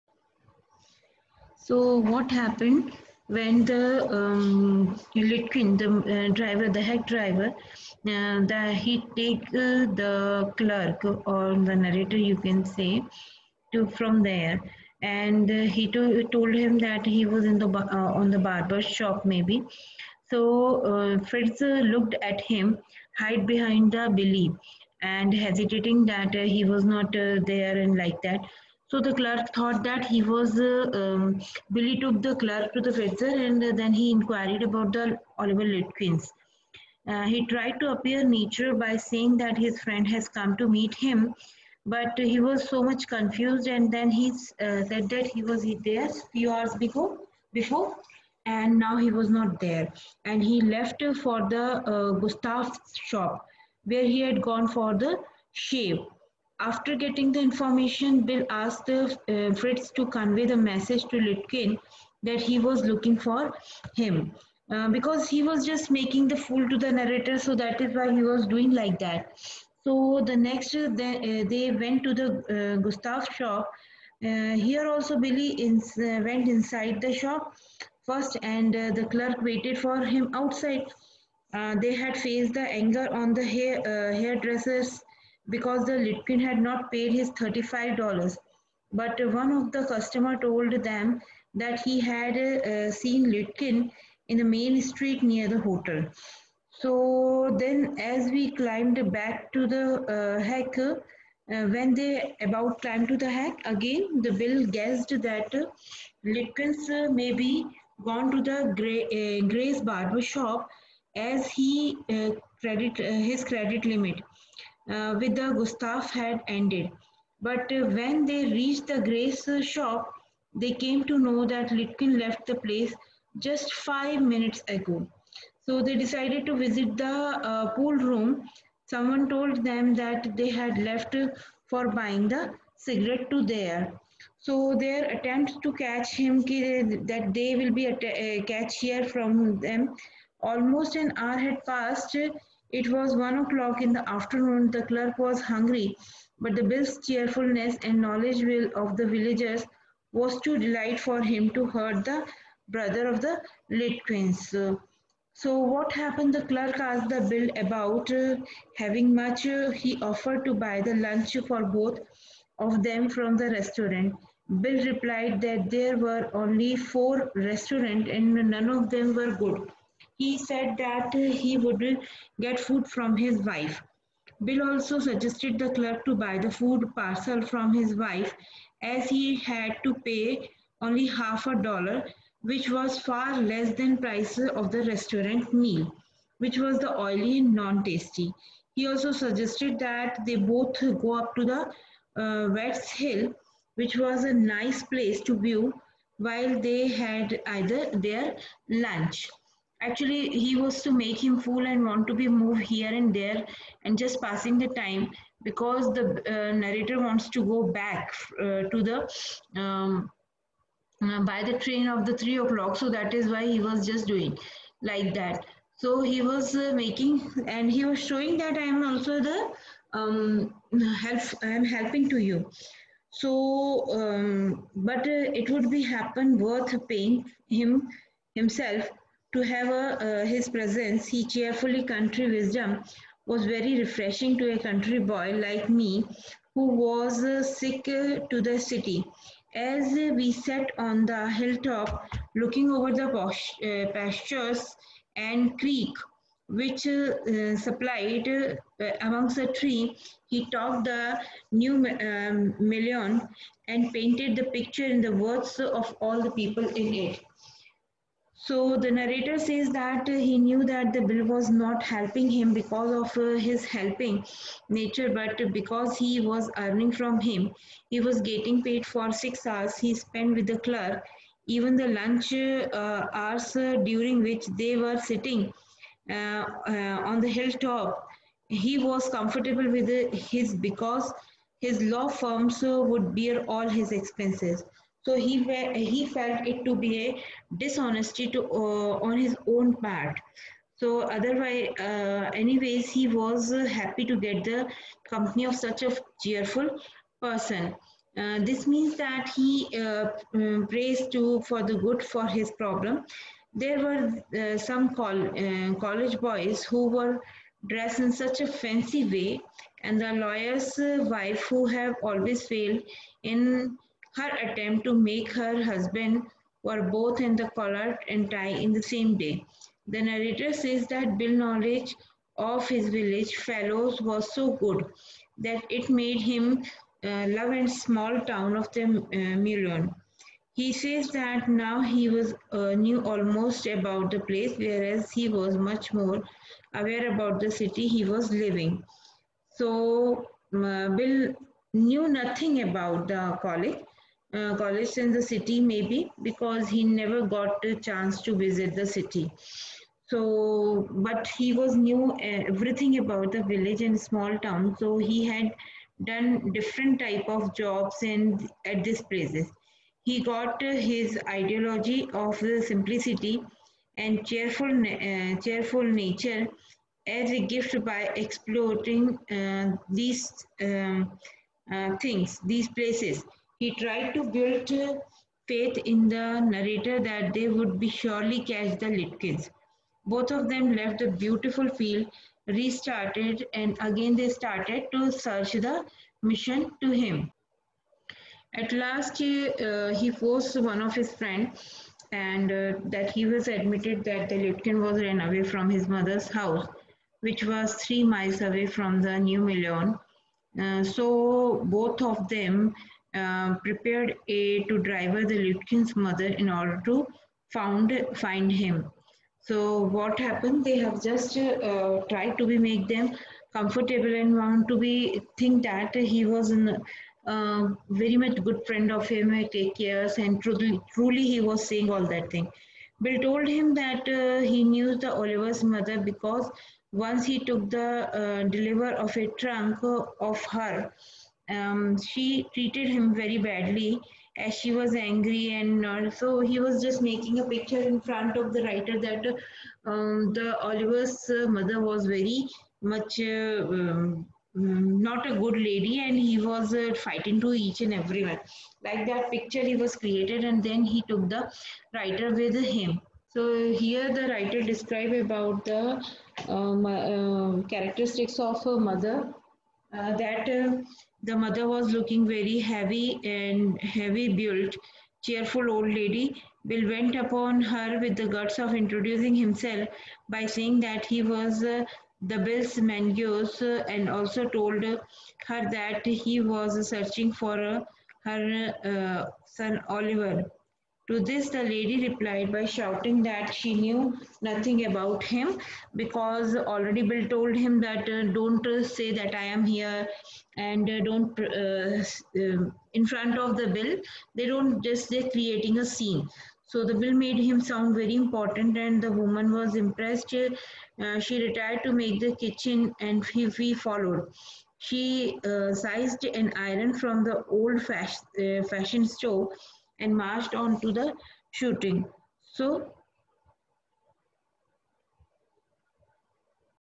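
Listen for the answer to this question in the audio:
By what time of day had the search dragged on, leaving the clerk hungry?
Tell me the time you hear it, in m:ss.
2:23.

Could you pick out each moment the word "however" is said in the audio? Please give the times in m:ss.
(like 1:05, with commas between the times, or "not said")
not said.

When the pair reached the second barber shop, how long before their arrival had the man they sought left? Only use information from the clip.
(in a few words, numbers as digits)
5 minutes.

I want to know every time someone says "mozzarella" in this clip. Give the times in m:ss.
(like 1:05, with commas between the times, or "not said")
not said.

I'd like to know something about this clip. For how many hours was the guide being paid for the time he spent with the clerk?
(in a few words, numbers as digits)
6.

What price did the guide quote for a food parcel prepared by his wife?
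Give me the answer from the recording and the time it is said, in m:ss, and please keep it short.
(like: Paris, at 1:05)
Half a dollar, at 3:01.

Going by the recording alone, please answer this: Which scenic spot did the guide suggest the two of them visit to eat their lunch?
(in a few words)
Wade's Hill.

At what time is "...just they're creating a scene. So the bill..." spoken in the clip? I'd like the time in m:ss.
8:14.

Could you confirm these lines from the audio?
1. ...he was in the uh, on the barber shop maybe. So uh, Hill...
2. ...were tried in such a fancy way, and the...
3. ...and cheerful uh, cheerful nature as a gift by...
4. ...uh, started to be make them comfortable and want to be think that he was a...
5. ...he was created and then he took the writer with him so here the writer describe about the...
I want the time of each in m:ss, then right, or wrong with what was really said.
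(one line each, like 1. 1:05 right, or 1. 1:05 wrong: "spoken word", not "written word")
1. 0:17 wrong: "Fritz", not "Hill"
2. 5:06 wrong: "dressed", not "tried"
3. 6:03 right
4. 6:51 wrong: "tried", not "started"
5. 7:29 right.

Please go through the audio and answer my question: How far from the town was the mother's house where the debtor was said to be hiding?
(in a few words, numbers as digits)
3 miles.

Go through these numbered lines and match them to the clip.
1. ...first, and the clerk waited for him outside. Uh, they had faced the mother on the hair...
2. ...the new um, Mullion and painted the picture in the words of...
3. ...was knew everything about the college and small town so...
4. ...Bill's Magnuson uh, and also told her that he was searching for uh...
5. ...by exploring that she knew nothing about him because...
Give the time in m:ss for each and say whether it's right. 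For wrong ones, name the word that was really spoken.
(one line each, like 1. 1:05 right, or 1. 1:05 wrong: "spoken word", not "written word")
1. 1:18 wrong: "anger", not "mother"
2. 4:10 right
3. 5:51 wrong: "village", not "college"
4. 7:52 right
5. 8:02 wrong: "shouting", not "exploring".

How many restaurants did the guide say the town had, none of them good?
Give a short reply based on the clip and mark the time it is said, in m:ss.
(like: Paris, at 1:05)
4, at 2:46.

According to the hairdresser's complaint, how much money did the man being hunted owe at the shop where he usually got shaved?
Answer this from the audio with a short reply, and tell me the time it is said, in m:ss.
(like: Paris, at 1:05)
$35, at 1:27.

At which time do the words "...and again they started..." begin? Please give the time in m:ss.
6:23.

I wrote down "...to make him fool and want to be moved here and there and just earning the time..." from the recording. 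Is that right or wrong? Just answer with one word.
wrong.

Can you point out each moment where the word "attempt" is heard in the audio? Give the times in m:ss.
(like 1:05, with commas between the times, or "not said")
2:15, 5:14.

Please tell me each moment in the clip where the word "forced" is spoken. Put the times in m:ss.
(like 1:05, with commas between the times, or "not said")
6:30.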